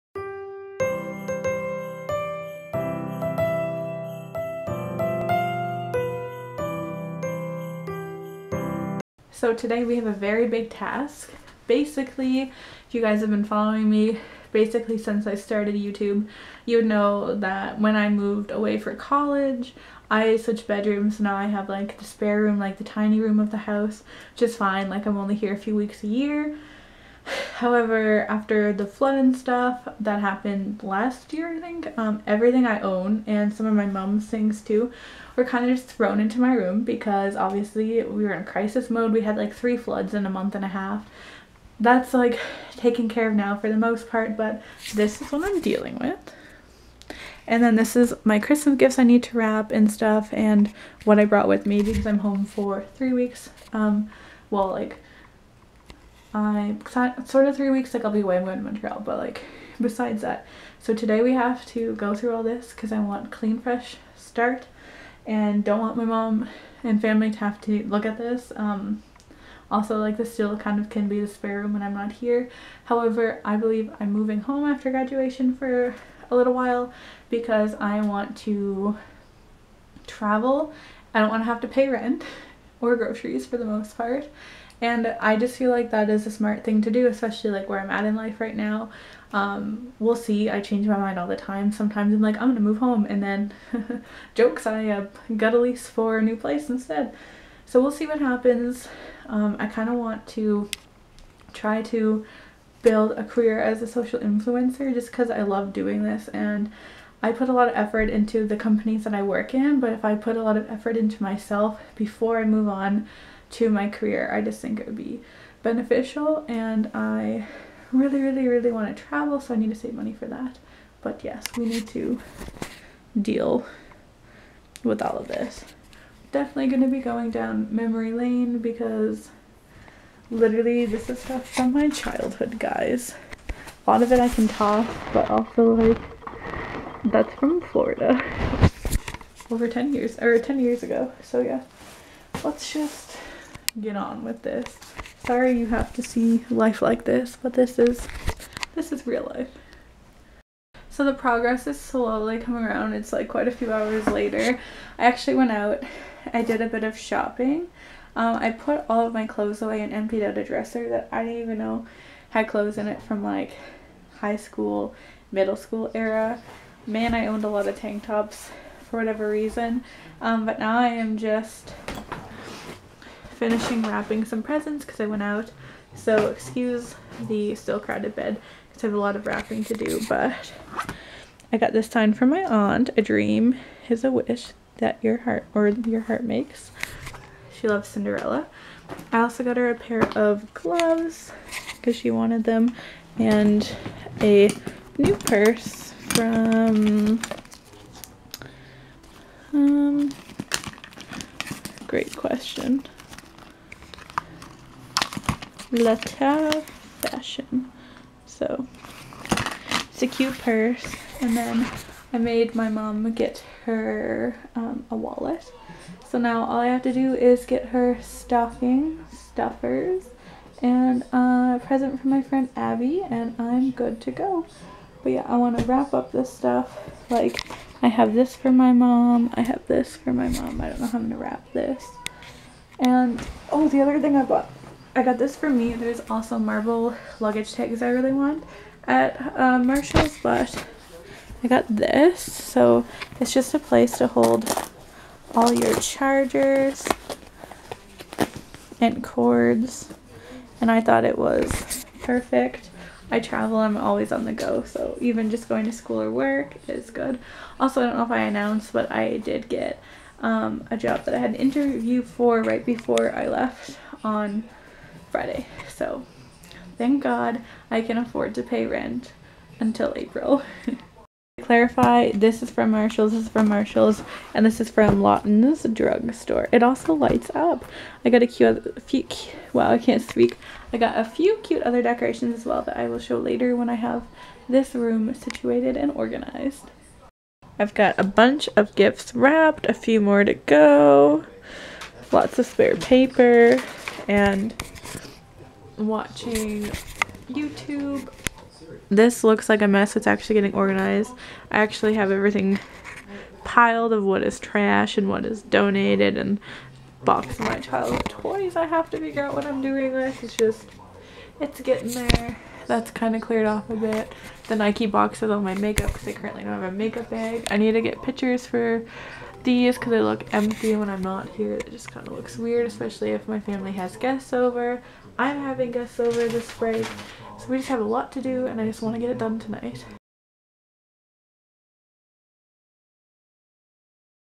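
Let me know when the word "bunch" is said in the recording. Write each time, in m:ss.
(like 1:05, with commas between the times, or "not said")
4:48.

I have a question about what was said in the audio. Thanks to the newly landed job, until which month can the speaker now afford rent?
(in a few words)
April.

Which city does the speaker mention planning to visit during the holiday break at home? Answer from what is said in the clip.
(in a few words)
Montreal.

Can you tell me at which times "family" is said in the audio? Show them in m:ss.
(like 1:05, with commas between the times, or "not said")
1:07, 5:23.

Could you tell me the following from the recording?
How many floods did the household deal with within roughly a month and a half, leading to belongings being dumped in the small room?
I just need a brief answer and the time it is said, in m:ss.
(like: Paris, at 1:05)
3, at 0:39.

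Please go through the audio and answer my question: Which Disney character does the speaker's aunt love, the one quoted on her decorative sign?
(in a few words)
Cinderella.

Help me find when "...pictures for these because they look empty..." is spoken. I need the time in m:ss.
5:18.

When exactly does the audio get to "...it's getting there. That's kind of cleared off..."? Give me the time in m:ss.
5:11.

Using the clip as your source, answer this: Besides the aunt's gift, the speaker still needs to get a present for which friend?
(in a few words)
Abby.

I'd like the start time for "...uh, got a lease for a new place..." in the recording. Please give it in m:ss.
1:34.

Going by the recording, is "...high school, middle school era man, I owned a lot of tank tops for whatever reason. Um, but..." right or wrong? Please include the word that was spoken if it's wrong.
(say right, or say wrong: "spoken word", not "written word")
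right.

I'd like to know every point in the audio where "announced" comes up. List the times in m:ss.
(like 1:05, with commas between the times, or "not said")
4:18.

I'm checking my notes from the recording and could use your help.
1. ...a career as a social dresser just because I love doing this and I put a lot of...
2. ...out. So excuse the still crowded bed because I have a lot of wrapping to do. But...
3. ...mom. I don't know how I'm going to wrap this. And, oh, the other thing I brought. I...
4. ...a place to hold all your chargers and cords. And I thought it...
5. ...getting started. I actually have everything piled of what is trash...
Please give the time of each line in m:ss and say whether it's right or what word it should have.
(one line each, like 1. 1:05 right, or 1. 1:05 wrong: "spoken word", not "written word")
1. 1:43 wrong: "influencer", not "dresser"
2. 2:55 right
3. 3:50 wrong: "bought", not "brought"
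4. 4:03 right
5. 5:00 wrong: "organized", not "started".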